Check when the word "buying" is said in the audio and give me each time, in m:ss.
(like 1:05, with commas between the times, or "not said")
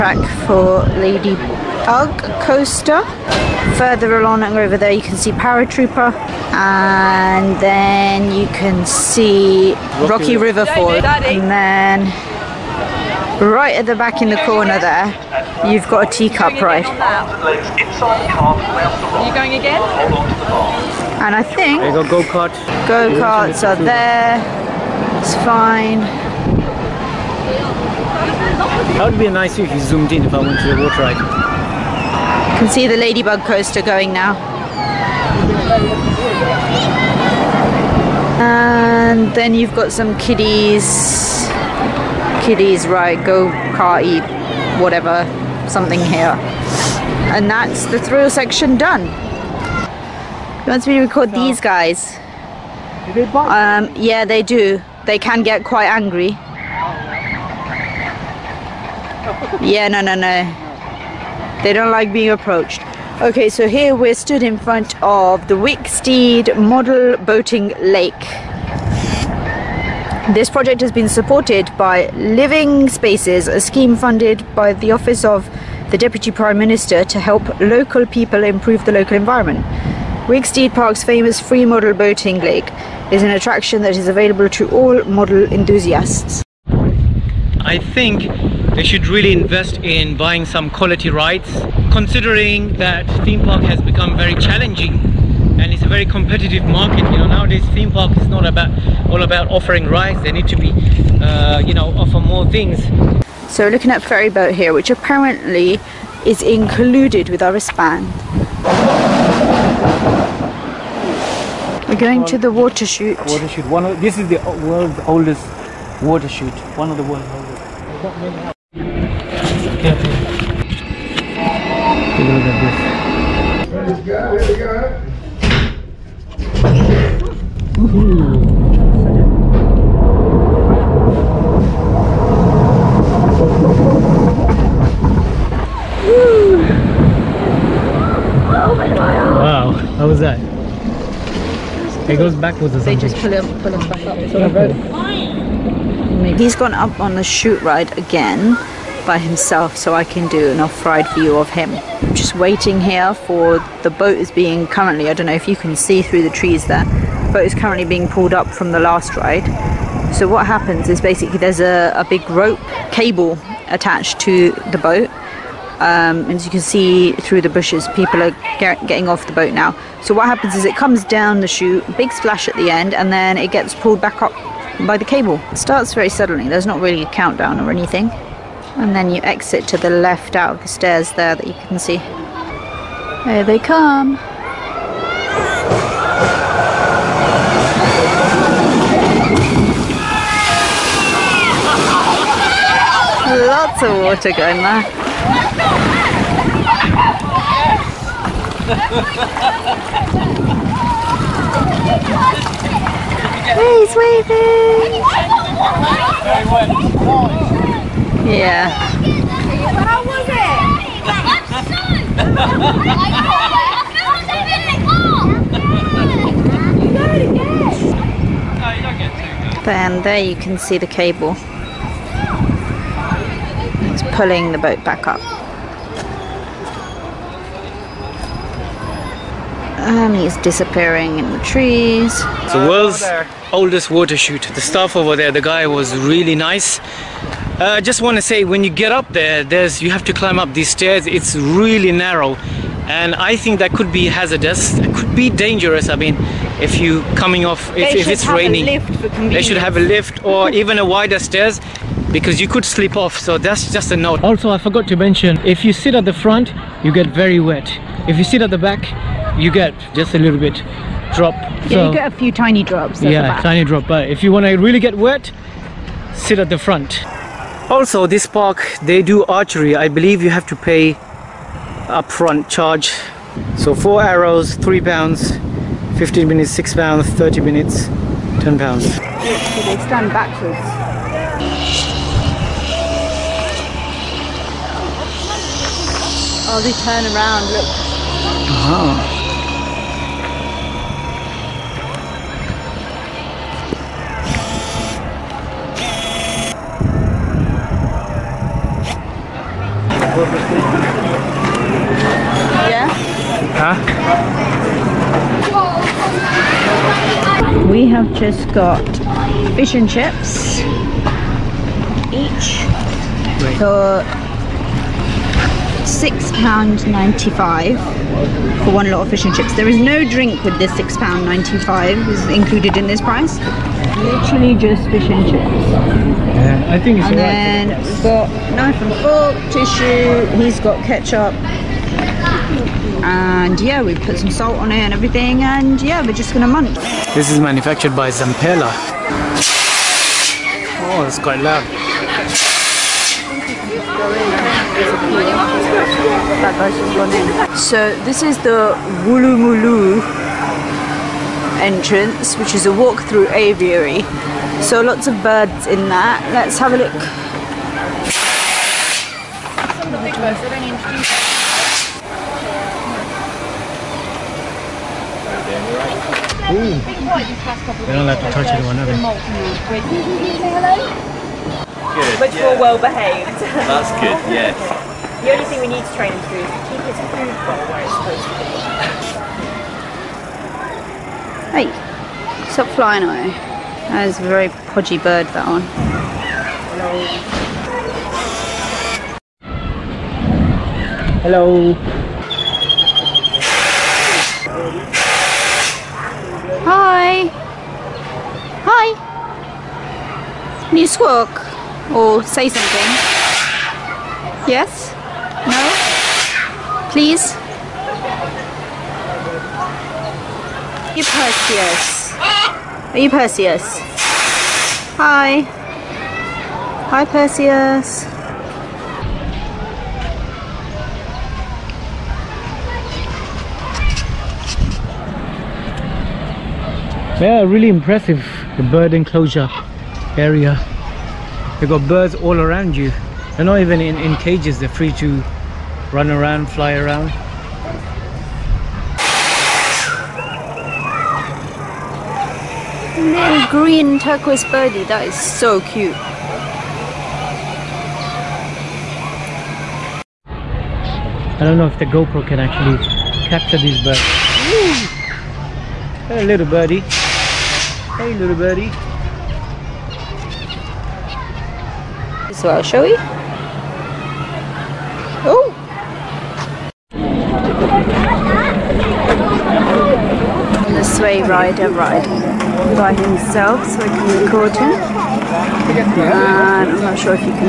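1:30.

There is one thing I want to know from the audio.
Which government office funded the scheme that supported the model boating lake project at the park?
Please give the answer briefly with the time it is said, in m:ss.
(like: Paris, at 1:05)
Office of the Deputy Prime Minister, at 1:14.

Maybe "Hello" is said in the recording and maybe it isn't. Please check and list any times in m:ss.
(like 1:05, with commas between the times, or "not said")
6:31, 6:36.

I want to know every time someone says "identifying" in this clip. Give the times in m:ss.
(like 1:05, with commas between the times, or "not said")
not said.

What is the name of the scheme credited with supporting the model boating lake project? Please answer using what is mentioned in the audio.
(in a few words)
Living Spaces.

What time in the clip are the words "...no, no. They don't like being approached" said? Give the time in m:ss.
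1:00.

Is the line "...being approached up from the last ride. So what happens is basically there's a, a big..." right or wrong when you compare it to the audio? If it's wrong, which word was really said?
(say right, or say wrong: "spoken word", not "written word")
wrong: "pulled", not "approached".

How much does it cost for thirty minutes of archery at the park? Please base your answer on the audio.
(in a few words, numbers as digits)
£10.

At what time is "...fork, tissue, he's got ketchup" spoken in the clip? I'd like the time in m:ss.
5:29.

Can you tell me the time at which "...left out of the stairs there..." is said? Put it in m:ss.
2:59.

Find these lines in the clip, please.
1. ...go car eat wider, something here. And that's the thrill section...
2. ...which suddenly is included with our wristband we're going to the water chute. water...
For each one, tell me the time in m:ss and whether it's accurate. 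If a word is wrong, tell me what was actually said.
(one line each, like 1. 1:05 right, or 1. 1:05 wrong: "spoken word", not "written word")
1. 0:43 wrong: "whatever", not "wider"
2. 1:44 wrong: "apparently", not "suddenly".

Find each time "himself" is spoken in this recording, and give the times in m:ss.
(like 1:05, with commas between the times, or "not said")
2:29, 7:52.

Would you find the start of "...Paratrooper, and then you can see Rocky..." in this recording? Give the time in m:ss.
0:05.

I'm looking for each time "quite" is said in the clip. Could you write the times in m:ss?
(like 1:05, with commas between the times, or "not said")
0:55, 5:41.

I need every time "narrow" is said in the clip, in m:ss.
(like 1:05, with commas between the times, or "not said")
4:01.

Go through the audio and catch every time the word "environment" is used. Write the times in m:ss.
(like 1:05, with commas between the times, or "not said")
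1:19.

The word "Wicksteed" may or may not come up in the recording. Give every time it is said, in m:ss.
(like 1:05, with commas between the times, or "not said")
1:05, 1:20.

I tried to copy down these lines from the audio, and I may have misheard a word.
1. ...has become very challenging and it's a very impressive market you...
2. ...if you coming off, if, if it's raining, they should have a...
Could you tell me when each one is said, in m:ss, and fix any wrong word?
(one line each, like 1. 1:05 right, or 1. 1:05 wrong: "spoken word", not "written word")
1. 1:33 wrong: "competitive", not "impressive"
2. 4:06 right.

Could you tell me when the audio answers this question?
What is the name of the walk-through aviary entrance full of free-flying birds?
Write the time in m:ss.
5:49.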